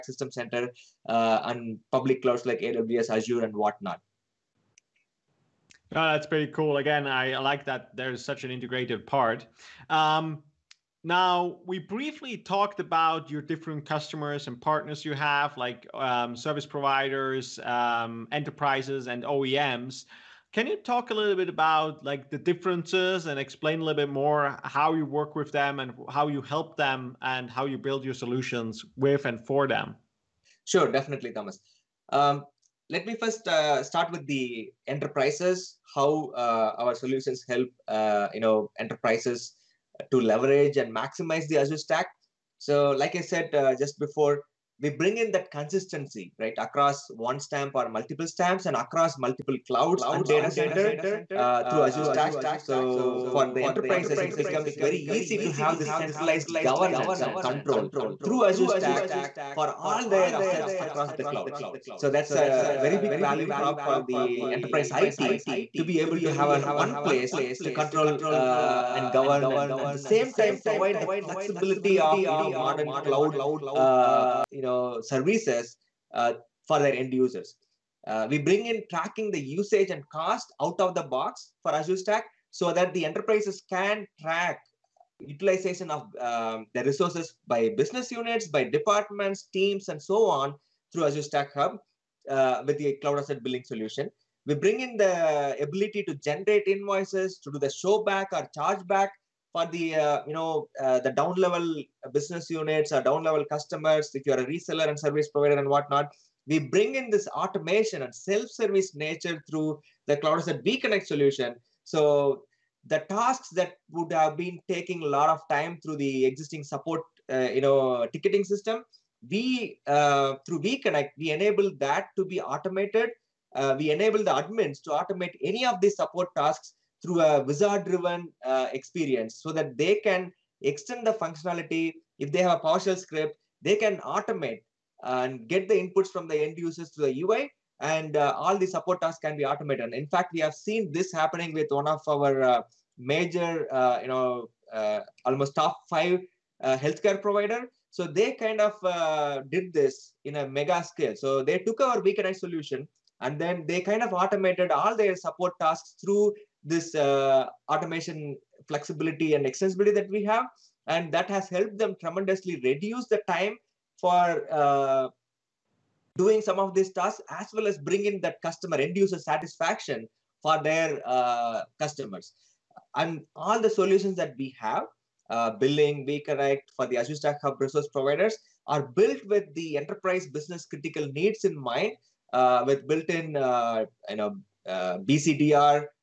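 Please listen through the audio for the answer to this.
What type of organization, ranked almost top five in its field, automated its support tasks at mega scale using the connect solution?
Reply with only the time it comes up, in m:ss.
2:26.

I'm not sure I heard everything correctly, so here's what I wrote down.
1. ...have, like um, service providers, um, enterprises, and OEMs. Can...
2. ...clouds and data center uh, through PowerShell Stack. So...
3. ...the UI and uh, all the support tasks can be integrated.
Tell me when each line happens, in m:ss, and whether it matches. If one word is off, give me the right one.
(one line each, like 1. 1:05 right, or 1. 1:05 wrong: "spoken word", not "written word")
1. 0:15 right
2. 0:49 wrong: "Azure", not "PowerShell"
3. 2:17 wrong: "automated", not "integrated".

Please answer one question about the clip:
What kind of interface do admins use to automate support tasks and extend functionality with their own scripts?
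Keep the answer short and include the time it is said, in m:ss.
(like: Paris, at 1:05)
Wizard-driven, at 2:07.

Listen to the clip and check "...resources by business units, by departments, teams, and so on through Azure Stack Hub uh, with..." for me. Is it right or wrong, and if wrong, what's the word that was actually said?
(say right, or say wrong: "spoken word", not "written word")
right.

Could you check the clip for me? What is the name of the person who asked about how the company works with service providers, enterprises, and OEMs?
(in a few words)
Thomas.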